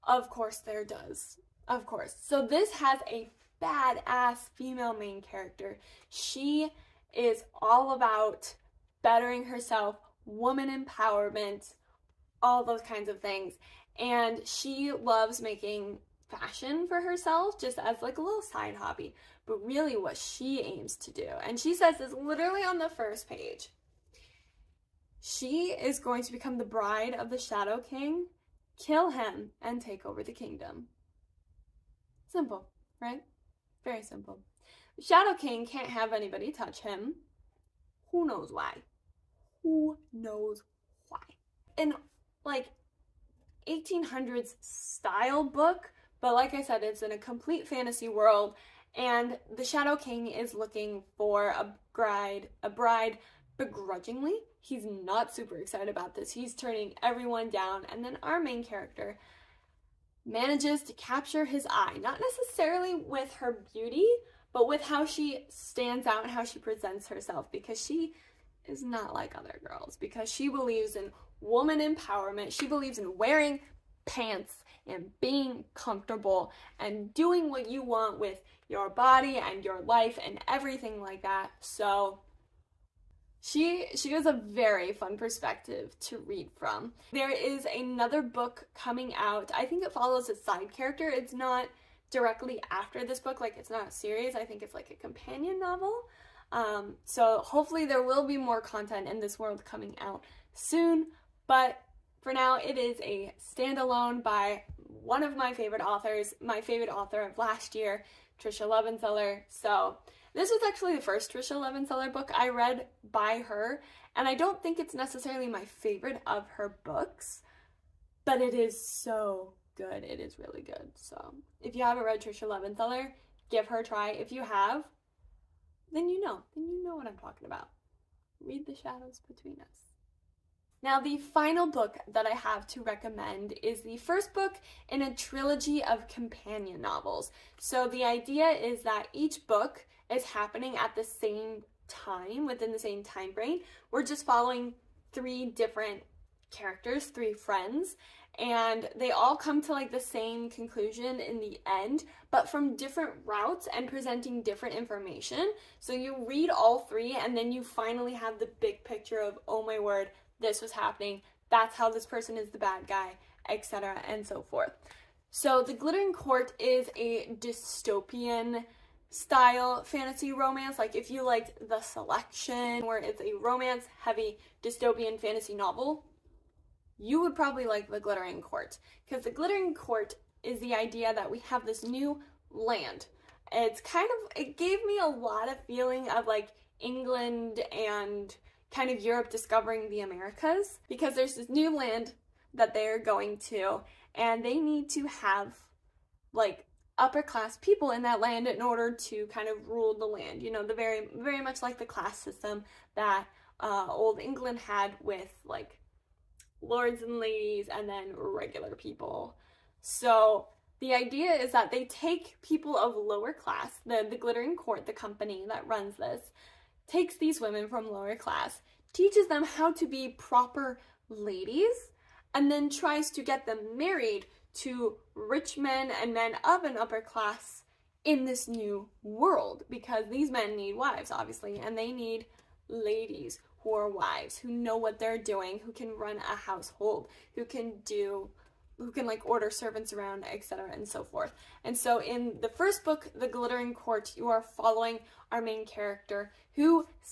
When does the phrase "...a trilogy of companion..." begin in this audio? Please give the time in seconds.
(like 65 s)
135 s.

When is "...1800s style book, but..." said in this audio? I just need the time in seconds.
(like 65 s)
43 s.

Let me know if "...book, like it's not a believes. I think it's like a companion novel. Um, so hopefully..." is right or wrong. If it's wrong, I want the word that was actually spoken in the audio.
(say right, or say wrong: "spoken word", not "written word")
wrong: "series", not "believes".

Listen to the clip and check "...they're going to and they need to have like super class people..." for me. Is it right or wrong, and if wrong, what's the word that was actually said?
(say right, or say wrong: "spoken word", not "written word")
wrong: "upper", not "super".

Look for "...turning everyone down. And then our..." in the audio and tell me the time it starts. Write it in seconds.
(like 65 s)
56 s.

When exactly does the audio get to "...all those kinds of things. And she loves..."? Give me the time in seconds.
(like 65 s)
12 s.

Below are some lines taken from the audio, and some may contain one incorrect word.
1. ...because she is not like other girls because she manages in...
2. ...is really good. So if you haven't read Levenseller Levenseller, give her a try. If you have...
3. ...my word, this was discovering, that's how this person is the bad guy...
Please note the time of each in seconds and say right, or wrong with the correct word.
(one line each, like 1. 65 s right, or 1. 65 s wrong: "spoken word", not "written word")
1. 67 s wrong: "believes", not "manages"
2. 120 s wrong: "Tricia", not "Levenseller"
3. 159 s wrong: "happening", not "discovering".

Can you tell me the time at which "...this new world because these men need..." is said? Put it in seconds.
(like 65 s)
228 s.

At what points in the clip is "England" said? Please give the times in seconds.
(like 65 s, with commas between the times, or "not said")
186 s, 204 s.